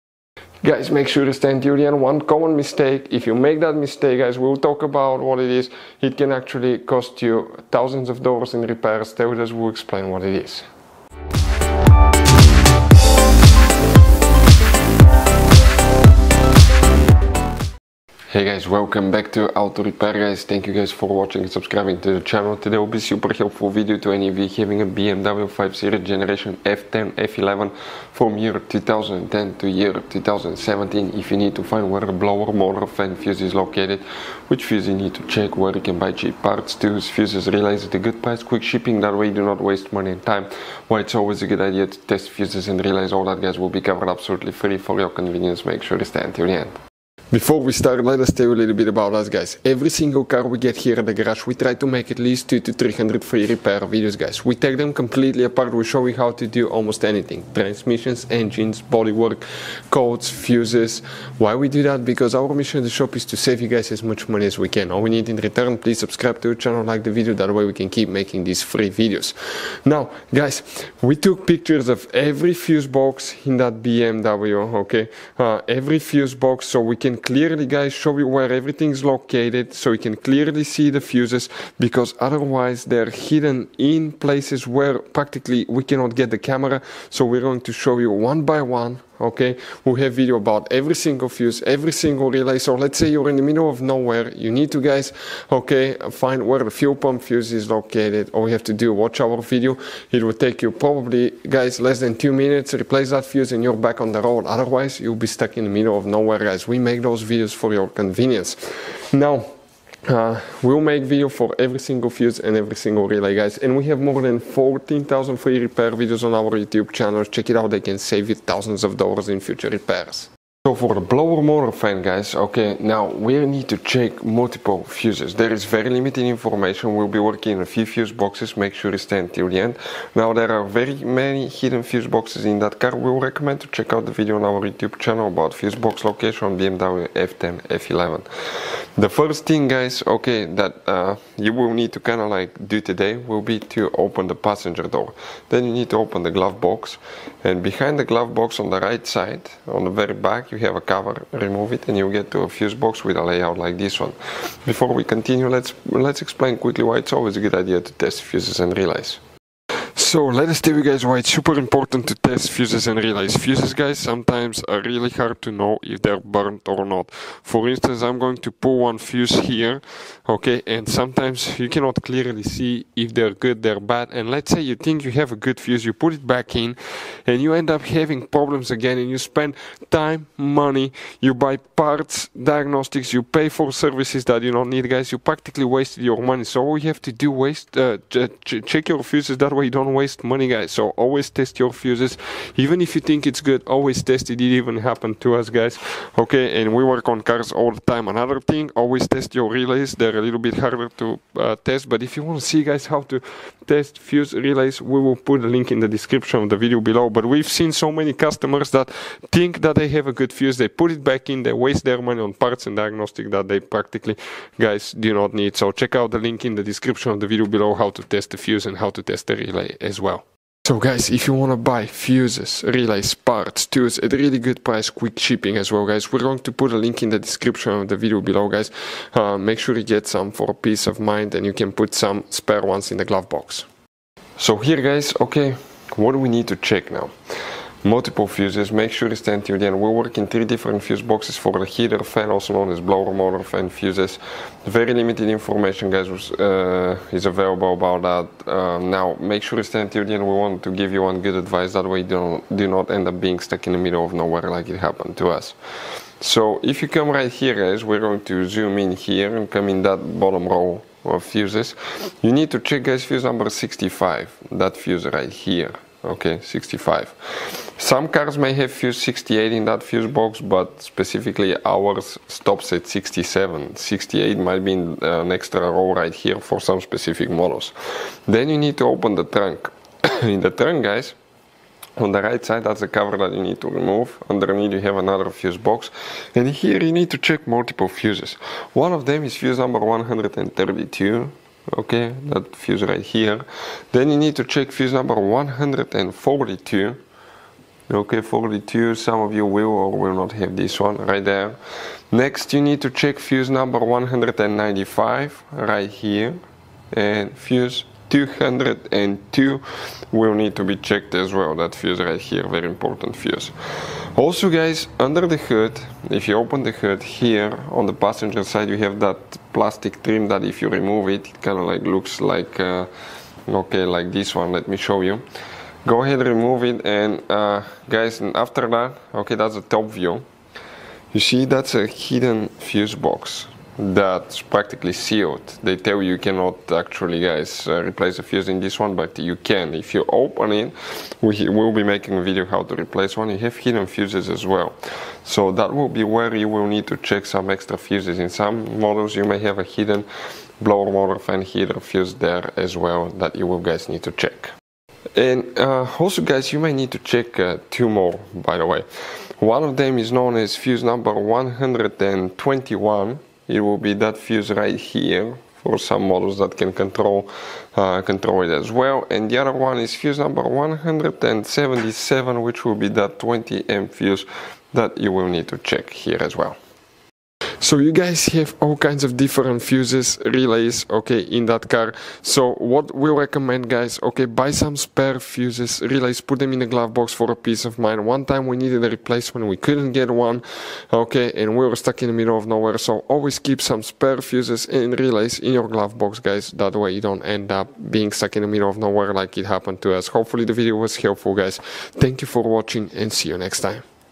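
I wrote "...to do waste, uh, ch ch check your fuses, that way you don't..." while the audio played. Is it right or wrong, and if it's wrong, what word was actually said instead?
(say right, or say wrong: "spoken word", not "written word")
right.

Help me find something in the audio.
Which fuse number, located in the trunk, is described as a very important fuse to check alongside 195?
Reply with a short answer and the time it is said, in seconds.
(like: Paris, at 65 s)
202, at 308 s.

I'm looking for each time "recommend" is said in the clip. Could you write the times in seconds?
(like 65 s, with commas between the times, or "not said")
133 s, 383 s.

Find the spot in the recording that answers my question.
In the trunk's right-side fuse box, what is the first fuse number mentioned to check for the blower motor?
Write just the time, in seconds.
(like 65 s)
289 s.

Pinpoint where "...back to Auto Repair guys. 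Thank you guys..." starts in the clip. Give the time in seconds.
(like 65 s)
19 s.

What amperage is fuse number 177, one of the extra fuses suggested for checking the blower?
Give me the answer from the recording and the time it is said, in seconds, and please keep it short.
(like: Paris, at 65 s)
20 amp, at 373 s.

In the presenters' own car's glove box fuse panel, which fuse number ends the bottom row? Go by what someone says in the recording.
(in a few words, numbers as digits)
67.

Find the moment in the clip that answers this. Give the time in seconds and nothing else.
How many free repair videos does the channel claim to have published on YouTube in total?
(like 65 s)
113 s.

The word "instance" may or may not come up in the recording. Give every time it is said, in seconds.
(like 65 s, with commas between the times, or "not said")
167 s.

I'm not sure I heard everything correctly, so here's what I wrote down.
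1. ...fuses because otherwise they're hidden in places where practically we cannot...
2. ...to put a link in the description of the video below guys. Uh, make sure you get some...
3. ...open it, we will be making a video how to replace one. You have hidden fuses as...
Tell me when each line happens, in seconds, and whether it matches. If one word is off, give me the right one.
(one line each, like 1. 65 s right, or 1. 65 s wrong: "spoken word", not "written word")
1. 81 s right
2. 226 s right
3. 340 s right.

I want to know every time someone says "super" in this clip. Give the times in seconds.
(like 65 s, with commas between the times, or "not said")
23 s, 161 s.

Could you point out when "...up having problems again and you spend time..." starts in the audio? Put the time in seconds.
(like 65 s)
177 s.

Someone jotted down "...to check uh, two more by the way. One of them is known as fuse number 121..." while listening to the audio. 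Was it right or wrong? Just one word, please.
right.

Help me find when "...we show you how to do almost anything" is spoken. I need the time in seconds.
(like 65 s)
55 s.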